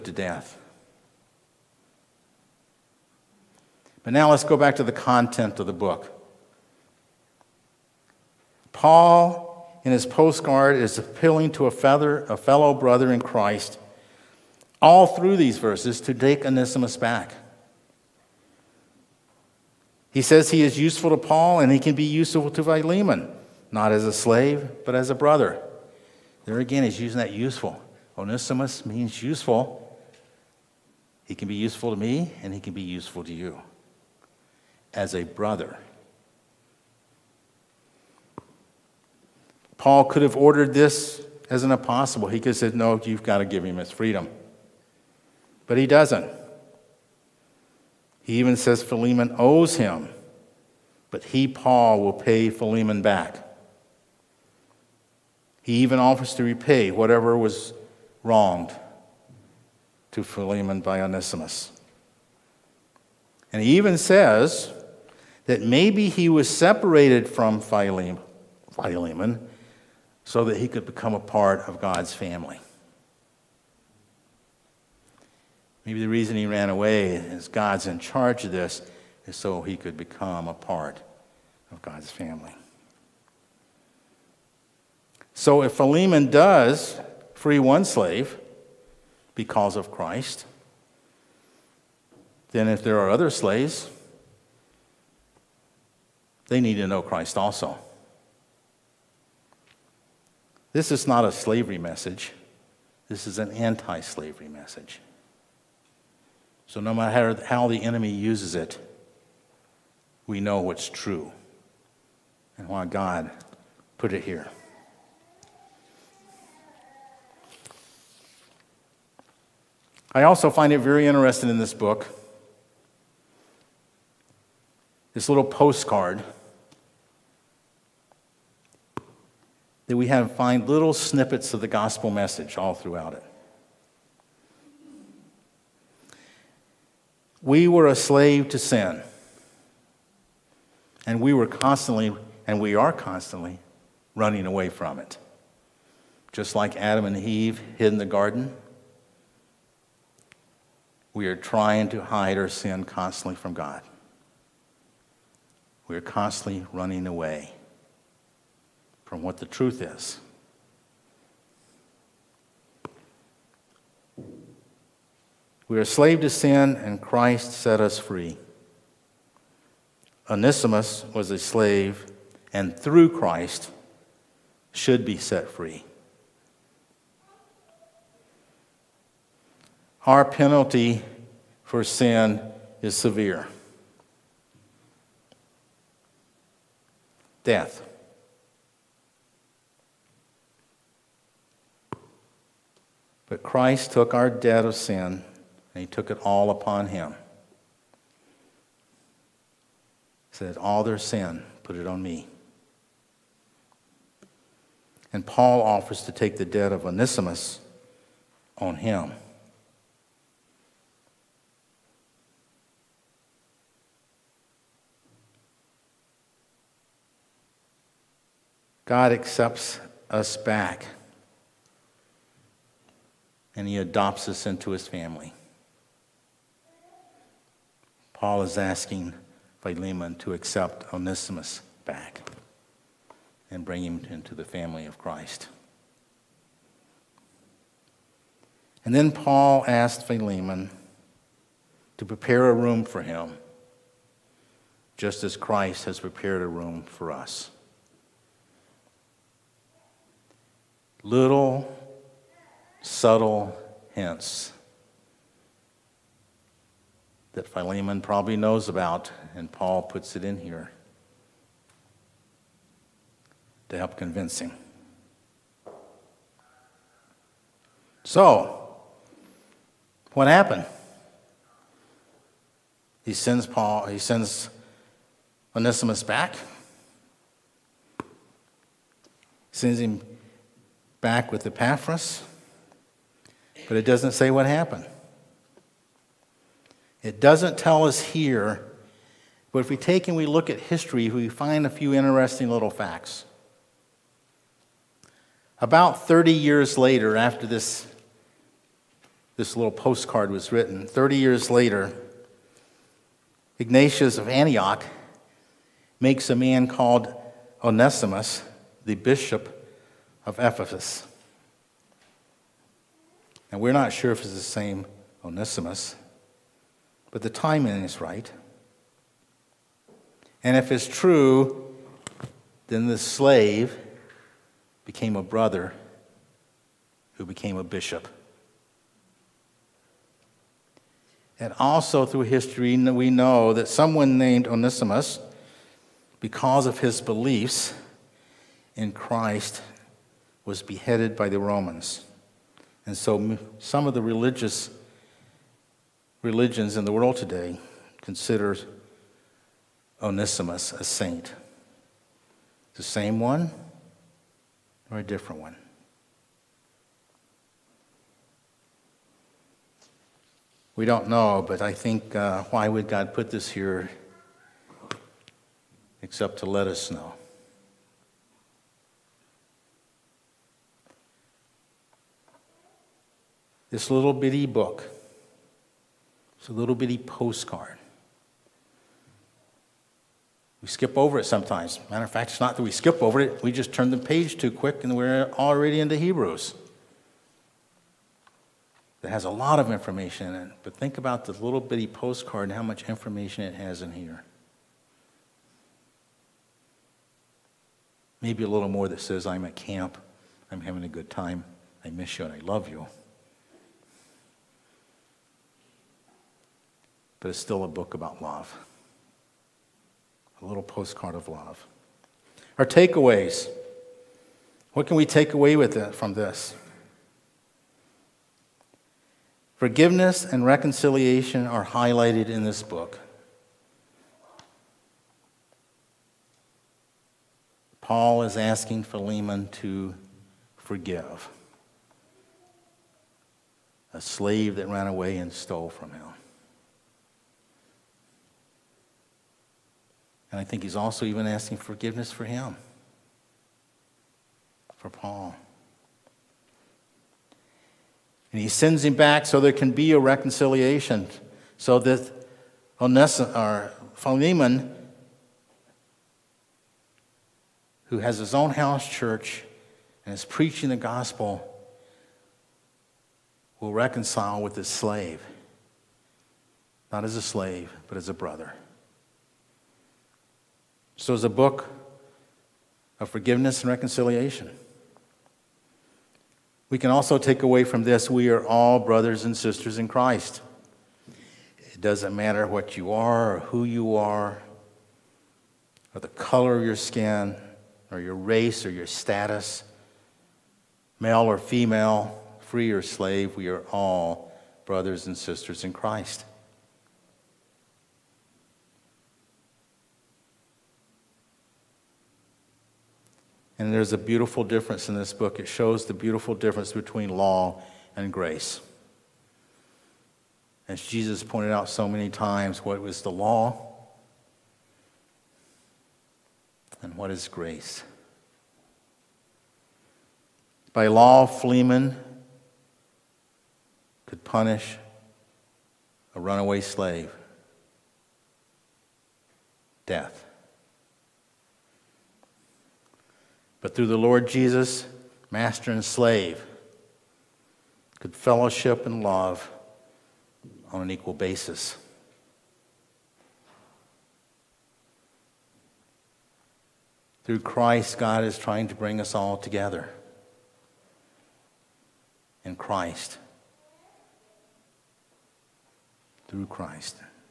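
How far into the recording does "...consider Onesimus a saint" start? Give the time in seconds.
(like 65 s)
348 s.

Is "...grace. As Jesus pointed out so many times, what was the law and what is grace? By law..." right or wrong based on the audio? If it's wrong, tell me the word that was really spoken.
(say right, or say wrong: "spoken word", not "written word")
right.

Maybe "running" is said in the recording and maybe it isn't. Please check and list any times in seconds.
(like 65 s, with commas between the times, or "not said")
144 s, 156 s.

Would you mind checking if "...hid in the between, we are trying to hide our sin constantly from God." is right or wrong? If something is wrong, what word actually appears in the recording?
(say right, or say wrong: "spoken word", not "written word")
wrong: "garden", not "between".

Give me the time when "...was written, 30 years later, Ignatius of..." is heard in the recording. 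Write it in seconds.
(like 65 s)
300 s.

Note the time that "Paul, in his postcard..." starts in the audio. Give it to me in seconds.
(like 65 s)
8 s.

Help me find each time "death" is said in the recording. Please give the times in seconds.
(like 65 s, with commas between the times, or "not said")
0 s, 187 s, 529 s.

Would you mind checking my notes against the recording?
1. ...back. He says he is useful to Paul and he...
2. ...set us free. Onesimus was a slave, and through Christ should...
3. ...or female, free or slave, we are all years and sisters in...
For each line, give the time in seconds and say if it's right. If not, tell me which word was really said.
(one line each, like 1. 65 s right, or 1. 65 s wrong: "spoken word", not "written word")
1. 16 s right
2. 167 s right
3. 491 s wrong: "brothers", not "years".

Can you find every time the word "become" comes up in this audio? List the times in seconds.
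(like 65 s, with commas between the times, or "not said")
70 s, 79 s.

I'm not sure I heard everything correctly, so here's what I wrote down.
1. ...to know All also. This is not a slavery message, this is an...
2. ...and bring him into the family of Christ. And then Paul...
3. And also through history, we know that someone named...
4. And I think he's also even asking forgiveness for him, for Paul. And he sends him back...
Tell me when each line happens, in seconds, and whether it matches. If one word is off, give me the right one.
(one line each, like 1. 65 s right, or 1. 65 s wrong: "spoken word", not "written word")
1. 96 s wrong: "Christ", not "All"
2. 233 s right
3. 331 s right
4. 440 s right.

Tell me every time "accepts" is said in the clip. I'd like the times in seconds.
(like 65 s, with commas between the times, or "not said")
219 s, 230 s.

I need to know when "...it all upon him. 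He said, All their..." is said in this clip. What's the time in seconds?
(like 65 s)
196 s.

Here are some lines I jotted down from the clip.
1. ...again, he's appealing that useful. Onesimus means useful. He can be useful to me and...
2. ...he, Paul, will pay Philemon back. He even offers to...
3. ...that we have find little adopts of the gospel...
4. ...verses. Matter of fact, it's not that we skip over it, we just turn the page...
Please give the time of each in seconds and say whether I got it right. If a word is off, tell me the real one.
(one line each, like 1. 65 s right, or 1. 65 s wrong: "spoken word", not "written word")
1. 26 s wrong: "using", not "appealing"
2. 51 s right
3. 129 s wrong: "snippets", not "adopts"
4. 381 s wrong: "sometimes", not "verses".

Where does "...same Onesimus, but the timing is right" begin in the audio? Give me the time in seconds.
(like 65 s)
314 s.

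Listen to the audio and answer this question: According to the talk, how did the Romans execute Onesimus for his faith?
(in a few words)
Beheaded.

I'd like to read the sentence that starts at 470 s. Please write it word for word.
So it's a book of forgiveness and reconciliation.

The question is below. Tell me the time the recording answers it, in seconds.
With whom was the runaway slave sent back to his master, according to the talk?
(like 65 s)
281 s.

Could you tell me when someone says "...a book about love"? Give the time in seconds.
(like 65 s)
407 s.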